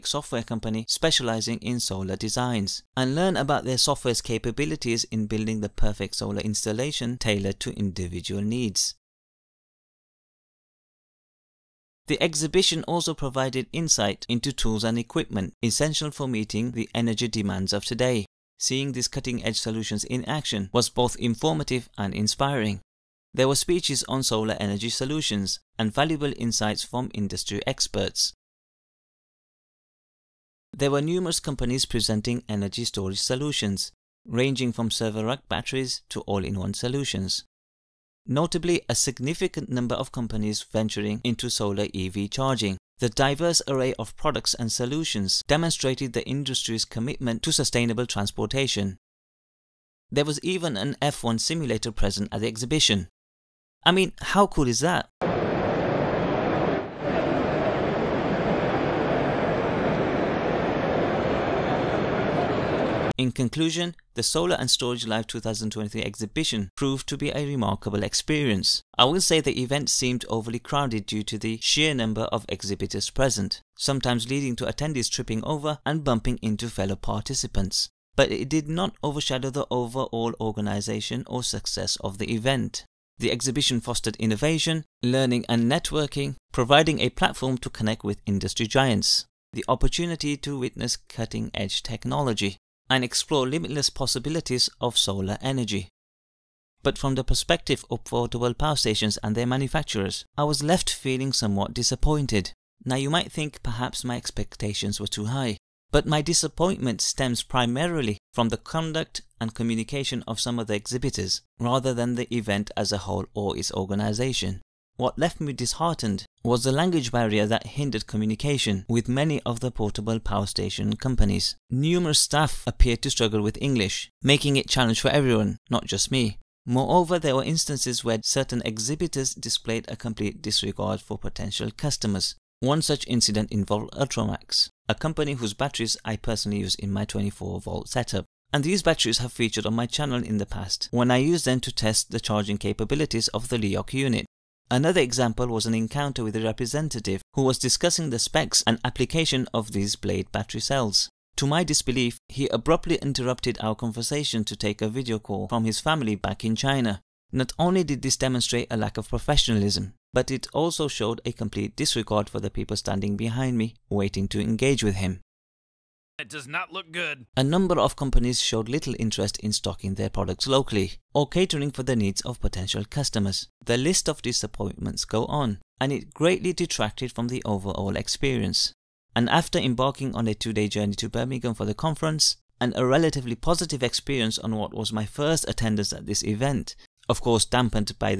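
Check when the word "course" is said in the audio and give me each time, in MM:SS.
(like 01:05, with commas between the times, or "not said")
03:07.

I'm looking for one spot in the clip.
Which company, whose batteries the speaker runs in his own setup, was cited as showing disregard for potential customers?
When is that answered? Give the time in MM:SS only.
02:13.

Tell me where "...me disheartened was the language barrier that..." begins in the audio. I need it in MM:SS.
01:55.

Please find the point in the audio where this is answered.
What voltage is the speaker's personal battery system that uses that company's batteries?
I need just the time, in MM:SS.
02:17.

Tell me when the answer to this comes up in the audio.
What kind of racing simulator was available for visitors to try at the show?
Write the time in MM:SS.
00:51.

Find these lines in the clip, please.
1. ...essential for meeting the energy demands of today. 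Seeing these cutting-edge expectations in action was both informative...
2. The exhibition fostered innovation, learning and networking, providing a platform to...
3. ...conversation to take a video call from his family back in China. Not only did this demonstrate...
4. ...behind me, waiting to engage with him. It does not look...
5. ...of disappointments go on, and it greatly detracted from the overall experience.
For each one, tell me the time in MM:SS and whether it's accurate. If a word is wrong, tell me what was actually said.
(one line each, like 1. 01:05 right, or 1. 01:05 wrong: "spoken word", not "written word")
1. 00:15 wrong: "solutions", not "expectations"
2. 01:23 right
3. 02:33 right
4. 02:43 right
5. 02:54 right.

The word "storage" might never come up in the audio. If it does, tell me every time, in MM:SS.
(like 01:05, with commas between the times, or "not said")
00:32, 01:04.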